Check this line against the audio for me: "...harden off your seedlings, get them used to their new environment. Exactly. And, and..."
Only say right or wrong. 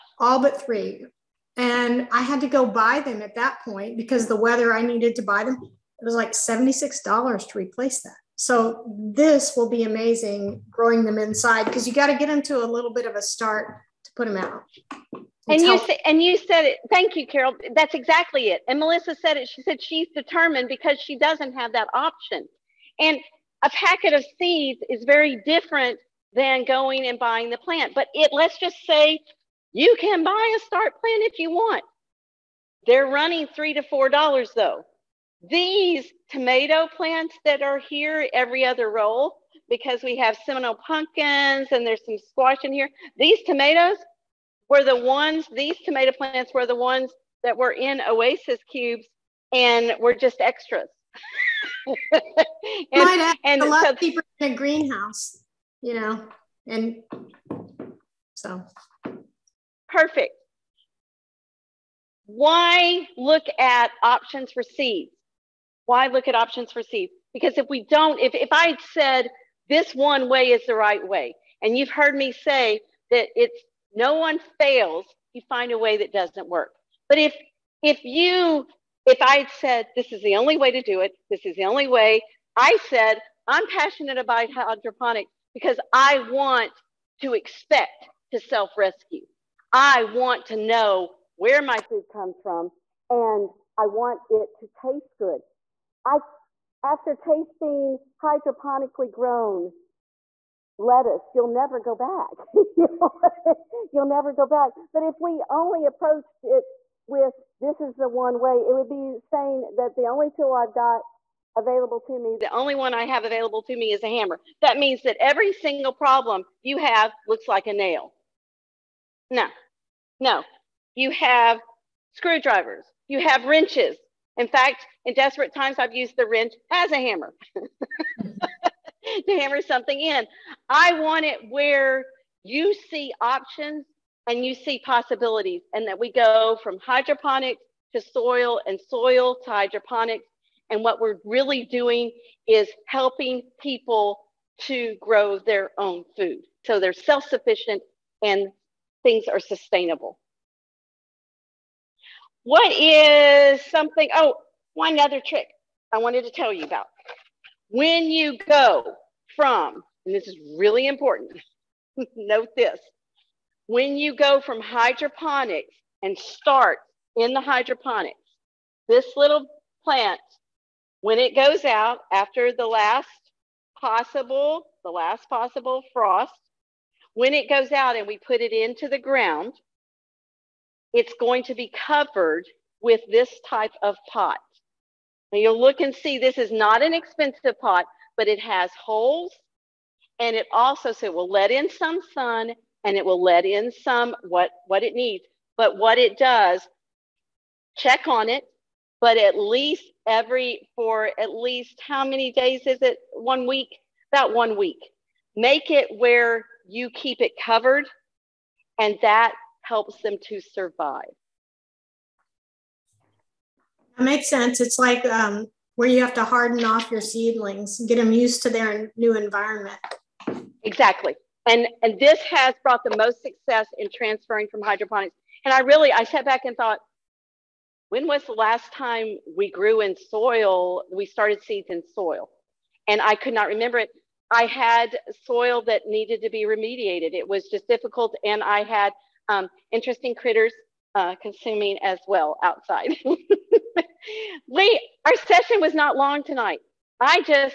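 right.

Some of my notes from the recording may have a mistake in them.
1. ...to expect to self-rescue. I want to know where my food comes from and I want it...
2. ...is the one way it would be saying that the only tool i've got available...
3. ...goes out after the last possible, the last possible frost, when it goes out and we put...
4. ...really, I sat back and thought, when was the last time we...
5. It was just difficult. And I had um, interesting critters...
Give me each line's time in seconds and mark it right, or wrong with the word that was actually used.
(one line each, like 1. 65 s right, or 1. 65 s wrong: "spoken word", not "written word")
1. 87 s right
2. 107 s right
3. 171 s right
4. 225 s right
5. 237 s right.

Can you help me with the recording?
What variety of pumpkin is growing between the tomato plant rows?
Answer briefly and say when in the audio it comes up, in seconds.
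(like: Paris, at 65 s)
Seminole, at 40 s.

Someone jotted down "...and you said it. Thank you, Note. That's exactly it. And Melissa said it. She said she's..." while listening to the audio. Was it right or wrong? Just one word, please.
wrong.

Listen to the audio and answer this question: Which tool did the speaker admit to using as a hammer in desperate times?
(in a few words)
wrench.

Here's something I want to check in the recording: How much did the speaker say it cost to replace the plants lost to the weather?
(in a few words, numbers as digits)
$76.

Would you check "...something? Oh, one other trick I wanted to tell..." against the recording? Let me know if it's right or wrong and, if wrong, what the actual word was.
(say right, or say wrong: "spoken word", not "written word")
right.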